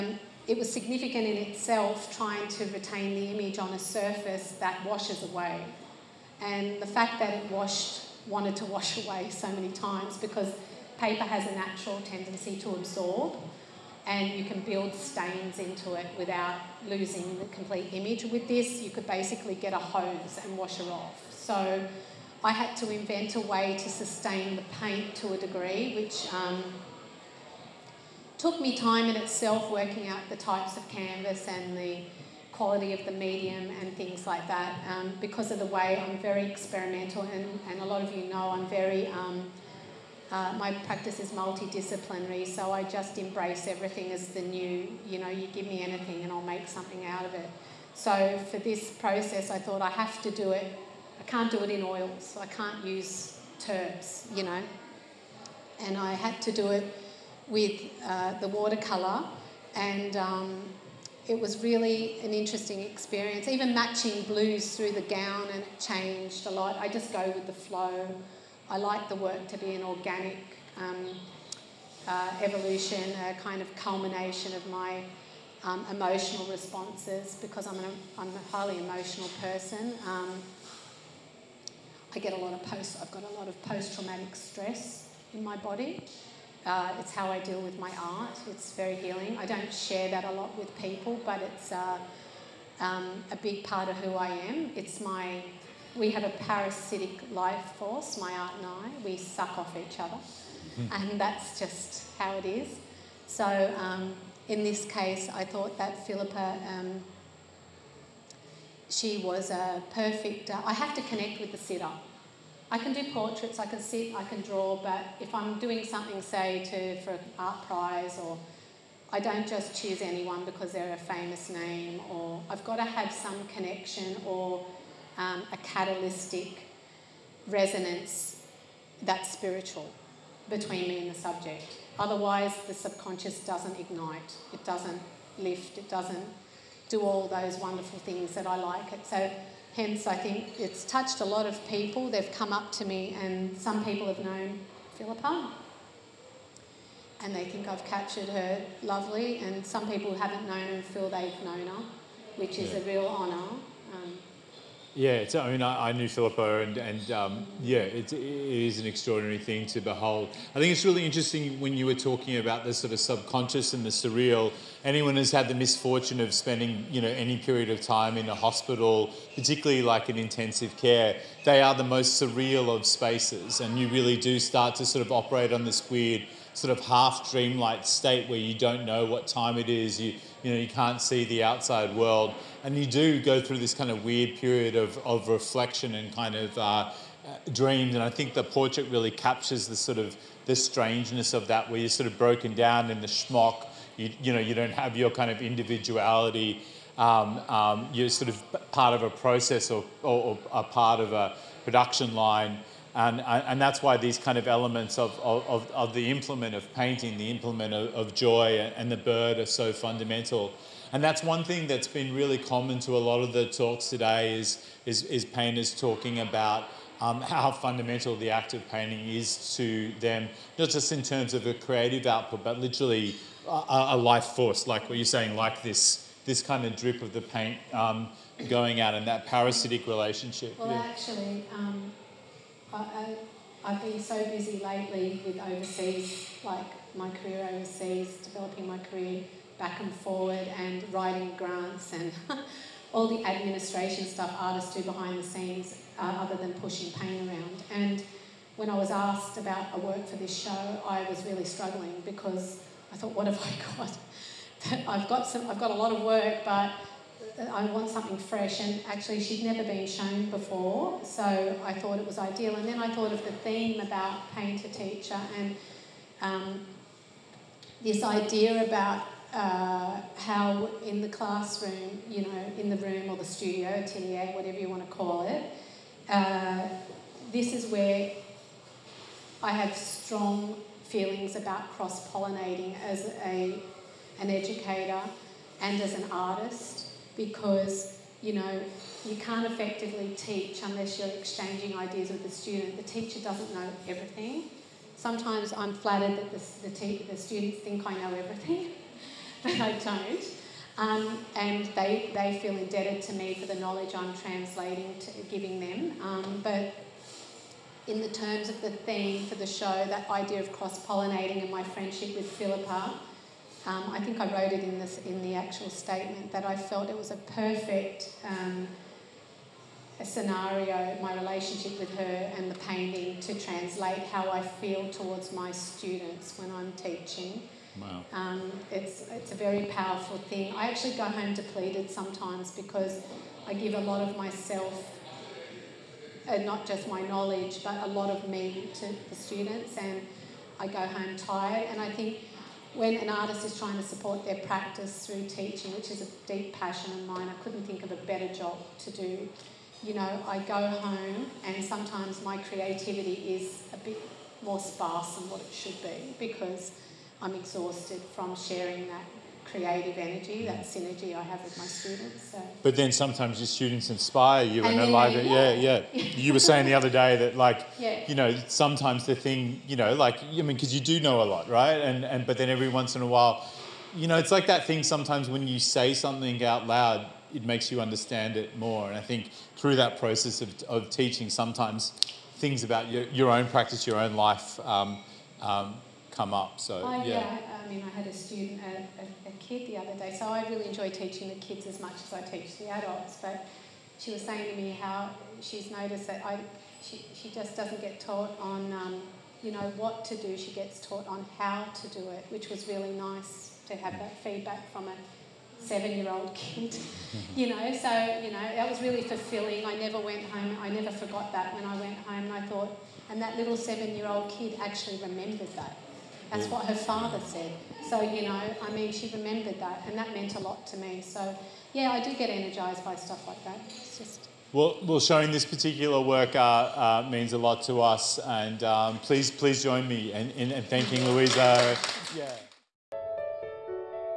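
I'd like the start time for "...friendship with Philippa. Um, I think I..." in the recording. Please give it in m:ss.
5:11.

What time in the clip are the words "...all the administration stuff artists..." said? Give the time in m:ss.
4:02.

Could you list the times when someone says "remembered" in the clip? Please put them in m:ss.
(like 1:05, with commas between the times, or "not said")
6:55, 6:59.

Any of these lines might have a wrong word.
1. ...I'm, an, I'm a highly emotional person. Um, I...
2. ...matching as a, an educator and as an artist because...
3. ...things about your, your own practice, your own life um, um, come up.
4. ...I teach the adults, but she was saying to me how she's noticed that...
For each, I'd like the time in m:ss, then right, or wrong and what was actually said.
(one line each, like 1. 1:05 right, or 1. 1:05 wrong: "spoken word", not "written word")
1. 1:17 right
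2. 4:42 wrong: "pollinating", not "matching"
3. 6:22 right
4. 6:32 right.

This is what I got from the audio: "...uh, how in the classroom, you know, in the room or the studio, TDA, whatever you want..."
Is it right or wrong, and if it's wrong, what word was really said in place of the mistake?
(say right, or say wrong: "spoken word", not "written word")
right.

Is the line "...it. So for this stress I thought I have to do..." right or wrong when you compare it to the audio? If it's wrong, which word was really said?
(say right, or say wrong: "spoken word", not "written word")
wrong: "process", not "stress".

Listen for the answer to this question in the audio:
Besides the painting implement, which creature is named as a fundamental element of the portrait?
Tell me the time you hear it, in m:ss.
3:28.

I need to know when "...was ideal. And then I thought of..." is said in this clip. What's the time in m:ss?
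4:22.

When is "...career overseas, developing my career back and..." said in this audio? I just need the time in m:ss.
3:57.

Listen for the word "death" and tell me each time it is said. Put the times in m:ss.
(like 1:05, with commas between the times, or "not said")
not said.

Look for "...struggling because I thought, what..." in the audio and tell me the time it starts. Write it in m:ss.
4:11.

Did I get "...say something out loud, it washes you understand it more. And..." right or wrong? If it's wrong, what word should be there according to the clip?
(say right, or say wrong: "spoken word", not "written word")
wrong: "makes", not "washes".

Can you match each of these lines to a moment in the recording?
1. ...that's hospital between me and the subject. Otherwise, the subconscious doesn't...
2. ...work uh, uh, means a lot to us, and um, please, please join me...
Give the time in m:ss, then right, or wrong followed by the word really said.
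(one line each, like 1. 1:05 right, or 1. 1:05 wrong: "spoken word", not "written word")
1. 2:09 wrong: "spiritual", not "hospital"
2. 7:06 right.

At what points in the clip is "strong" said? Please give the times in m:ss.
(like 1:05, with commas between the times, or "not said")
4:39.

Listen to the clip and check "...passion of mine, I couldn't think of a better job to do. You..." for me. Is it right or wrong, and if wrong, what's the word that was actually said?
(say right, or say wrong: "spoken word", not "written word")
right.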